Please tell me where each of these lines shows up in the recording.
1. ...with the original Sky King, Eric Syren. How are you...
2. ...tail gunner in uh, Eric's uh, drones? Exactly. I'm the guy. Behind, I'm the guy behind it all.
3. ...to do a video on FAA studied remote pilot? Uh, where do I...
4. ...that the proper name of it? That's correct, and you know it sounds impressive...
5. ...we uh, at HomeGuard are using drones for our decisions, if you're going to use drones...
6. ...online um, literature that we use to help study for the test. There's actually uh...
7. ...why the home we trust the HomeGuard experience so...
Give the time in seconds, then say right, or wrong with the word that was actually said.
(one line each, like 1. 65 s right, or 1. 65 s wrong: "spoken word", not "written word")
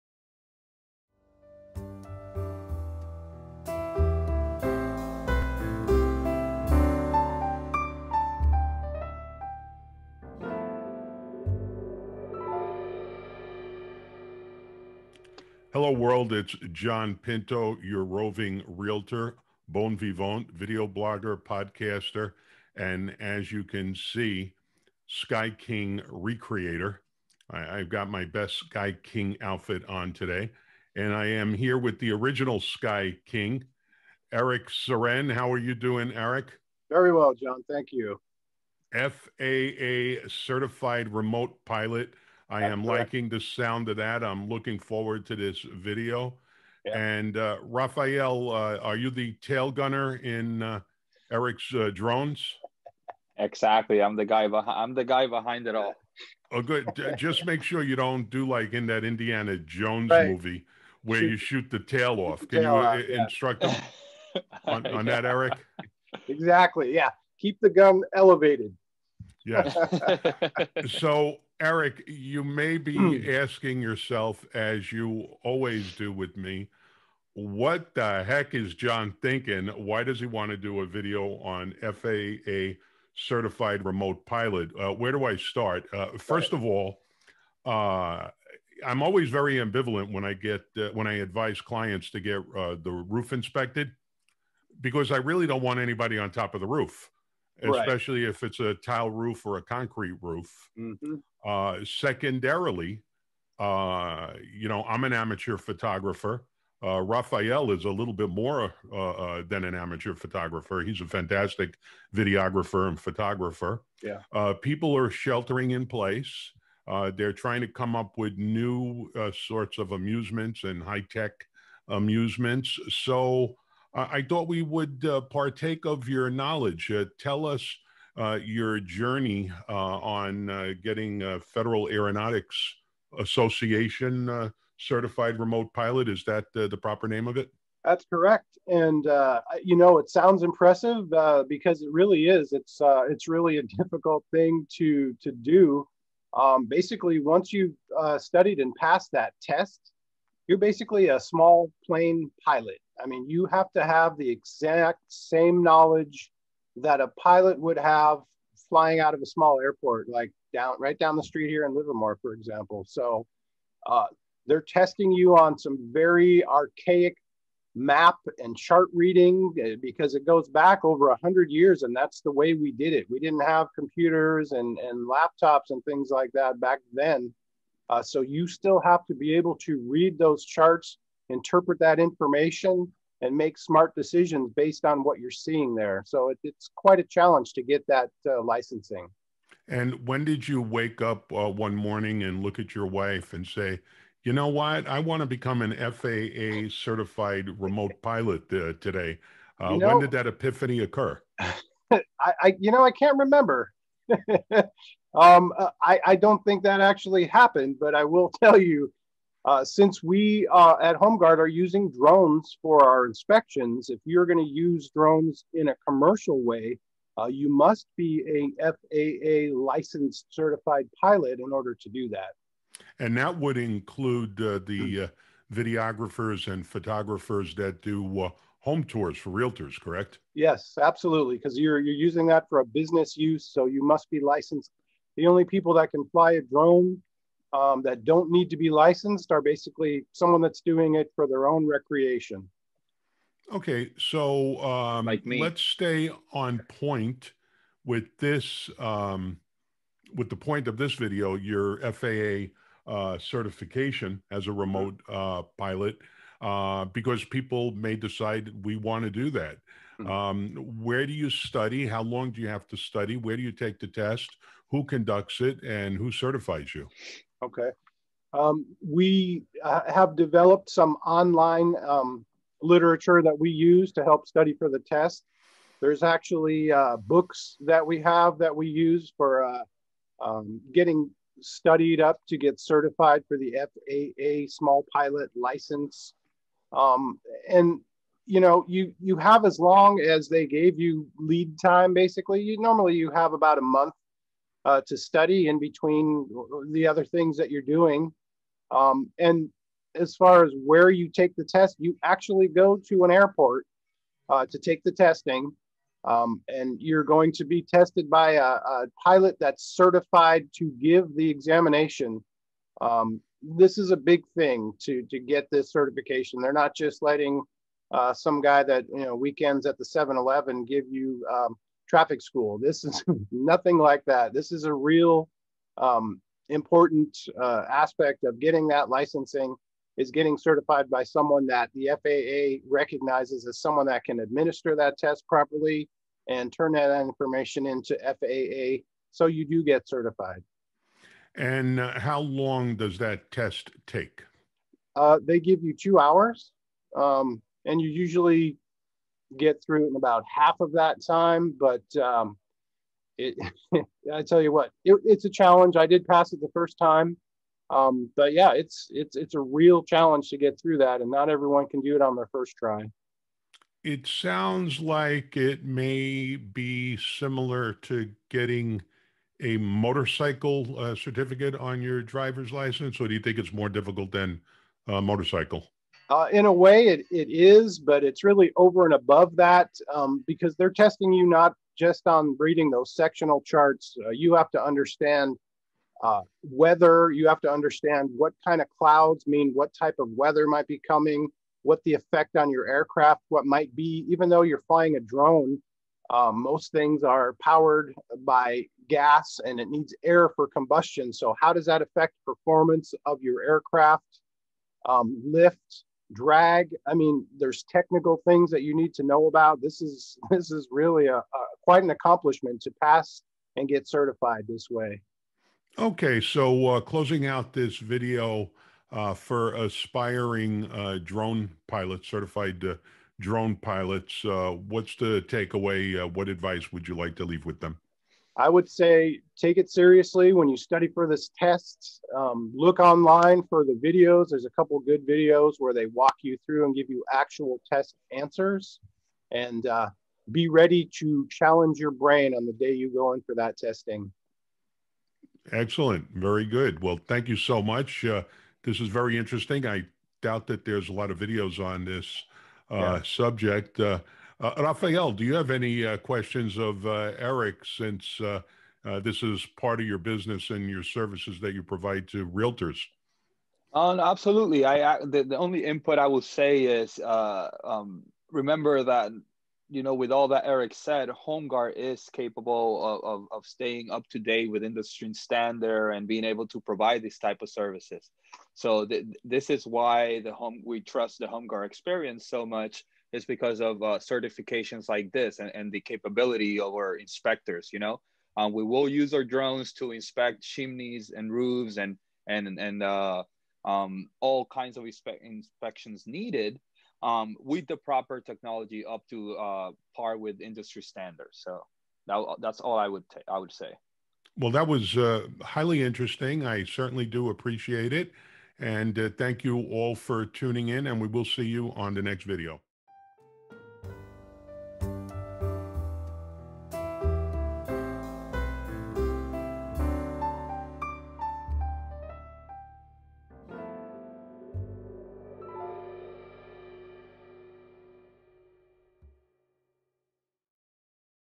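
1. 31 s right
2. 49 s right
3. 80 s wrong: "certified", not "studied"
4. 136 s right
5. 210 s wrong: "inspections", not "decisions"
6. 271 s right
7. 479 s right.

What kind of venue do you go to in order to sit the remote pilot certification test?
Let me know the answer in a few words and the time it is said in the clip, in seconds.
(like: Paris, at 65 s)
an airport, at 303 s.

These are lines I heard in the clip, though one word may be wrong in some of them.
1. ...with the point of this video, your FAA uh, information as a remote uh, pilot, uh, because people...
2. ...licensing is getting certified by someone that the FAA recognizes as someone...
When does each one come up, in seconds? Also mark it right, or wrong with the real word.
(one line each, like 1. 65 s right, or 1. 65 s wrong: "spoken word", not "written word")
1. 250 s wrong: "certification", not "information"
2. 328 s right.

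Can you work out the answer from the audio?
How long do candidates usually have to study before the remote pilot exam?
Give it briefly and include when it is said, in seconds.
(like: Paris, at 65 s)
about a month, at 293 s.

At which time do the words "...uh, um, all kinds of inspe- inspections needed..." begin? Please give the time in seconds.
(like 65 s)
492 s.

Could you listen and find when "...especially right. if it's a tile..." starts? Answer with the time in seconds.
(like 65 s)
97 s.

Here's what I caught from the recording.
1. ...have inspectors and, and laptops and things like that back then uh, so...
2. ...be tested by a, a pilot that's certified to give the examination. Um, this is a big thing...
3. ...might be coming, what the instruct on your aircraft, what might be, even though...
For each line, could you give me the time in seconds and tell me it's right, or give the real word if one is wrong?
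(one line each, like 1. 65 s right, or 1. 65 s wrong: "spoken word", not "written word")
1. 173 s wrong: "computers", not "inspectors"
2. 307 s right
3. 390 s wrong: "effect", not "instruct".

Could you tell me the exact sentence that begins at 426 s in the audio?
Uh, what advice would you like to leave with them?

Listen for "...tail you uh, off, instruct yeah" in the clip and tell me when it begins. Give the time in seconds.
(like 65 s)
62 s.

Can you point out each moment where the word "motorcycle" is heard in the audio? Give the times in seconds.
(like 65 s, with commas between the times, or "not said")
369 s, 375 s.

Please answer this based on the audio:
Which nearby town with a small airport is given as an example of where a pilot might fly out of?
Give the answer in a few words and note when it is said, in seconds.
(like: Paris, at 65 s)
Livermore, at 161 s.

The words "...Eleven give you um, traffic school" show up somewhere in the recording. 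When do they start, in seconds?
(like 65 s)
320 s.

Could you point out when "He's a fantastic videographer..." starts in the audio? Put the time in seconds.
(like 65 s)
110 s.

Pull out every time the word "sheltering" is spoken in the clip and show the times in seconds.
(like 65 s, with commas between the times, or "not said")
115 s.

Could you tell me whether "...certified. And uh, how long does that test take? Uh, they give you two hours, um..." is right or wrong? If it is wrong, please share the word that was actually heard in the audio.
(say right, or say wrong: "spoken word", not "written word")
right.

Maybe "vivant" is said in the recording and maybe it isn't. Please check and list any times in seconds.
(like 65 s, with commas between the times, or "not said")
19 s.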